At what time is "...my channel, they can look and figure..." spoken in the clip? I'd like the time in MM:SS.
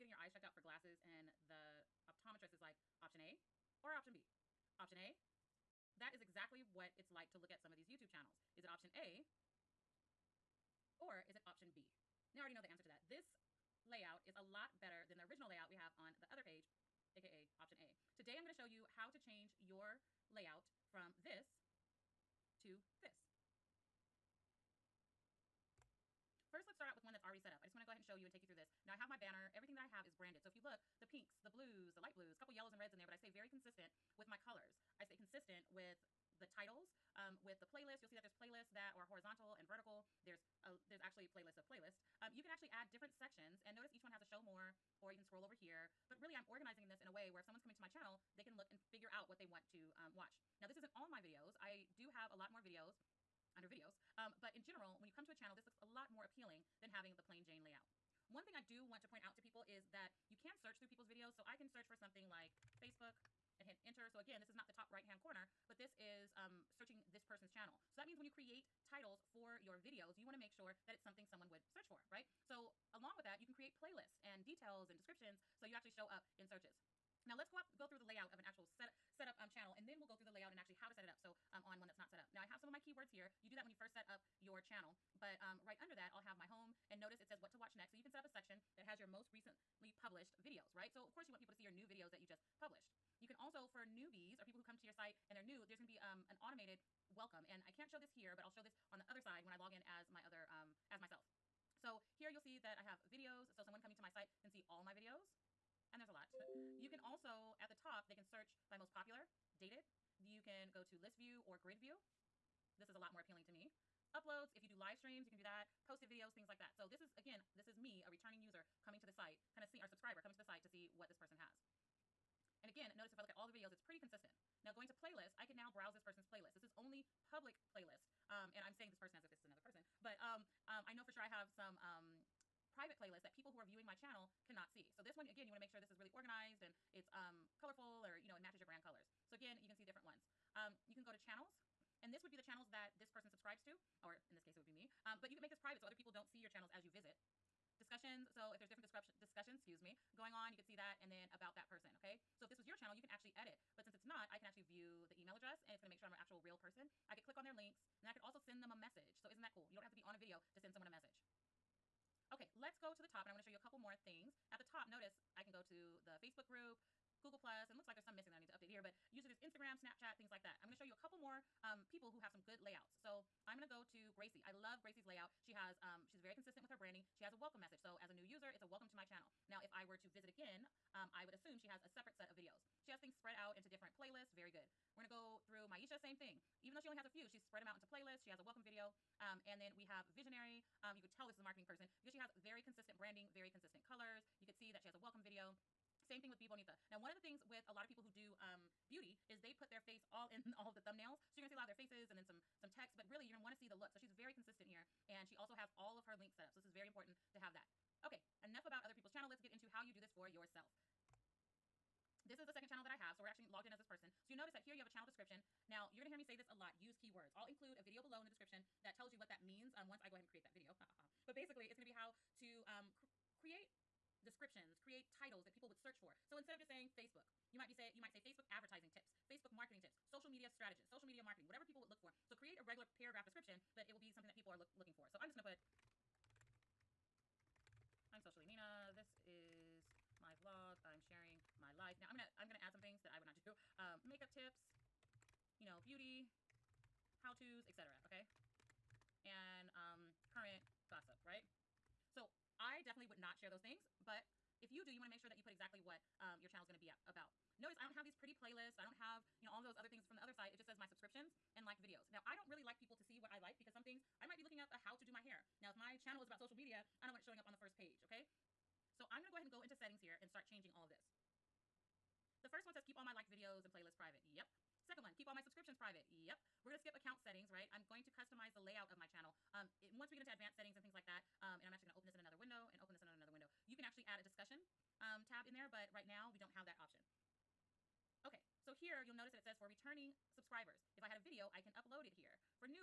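00:47.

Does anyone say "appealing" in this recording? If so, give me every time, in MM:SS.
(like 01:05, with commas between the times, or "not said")
00:56, 01:53.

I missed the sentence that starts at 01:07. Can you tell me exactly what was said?
So that means when you create titles for your videos, you wanna make sure that it's something someone would search for, right?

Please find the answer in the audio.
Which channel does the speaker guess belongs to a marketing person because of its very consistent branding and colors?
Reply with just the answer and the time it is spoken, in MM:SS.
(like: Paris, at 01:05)
Visionary, at 03:10.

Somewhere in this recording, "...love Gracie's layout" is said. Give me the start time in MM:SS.
02:54.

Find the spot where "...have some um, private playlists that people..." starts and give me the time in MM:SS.
02:11.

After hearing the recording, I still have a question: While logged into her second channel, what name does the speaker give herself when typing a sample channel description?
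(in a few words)
Socially Nina.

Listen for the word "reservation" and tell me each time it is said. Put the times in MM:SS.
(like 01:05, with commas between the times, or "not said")
not said.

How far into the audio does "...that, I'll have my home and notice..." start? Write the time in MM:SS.
01:25.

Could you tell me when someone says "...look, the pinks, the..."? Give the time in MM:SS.
00:30.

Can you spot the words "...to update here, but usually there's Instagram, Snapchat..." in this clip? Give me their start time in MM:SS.
02:48.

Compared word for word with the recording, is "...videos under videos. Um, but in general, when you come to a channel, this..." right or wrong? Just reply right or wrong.
right.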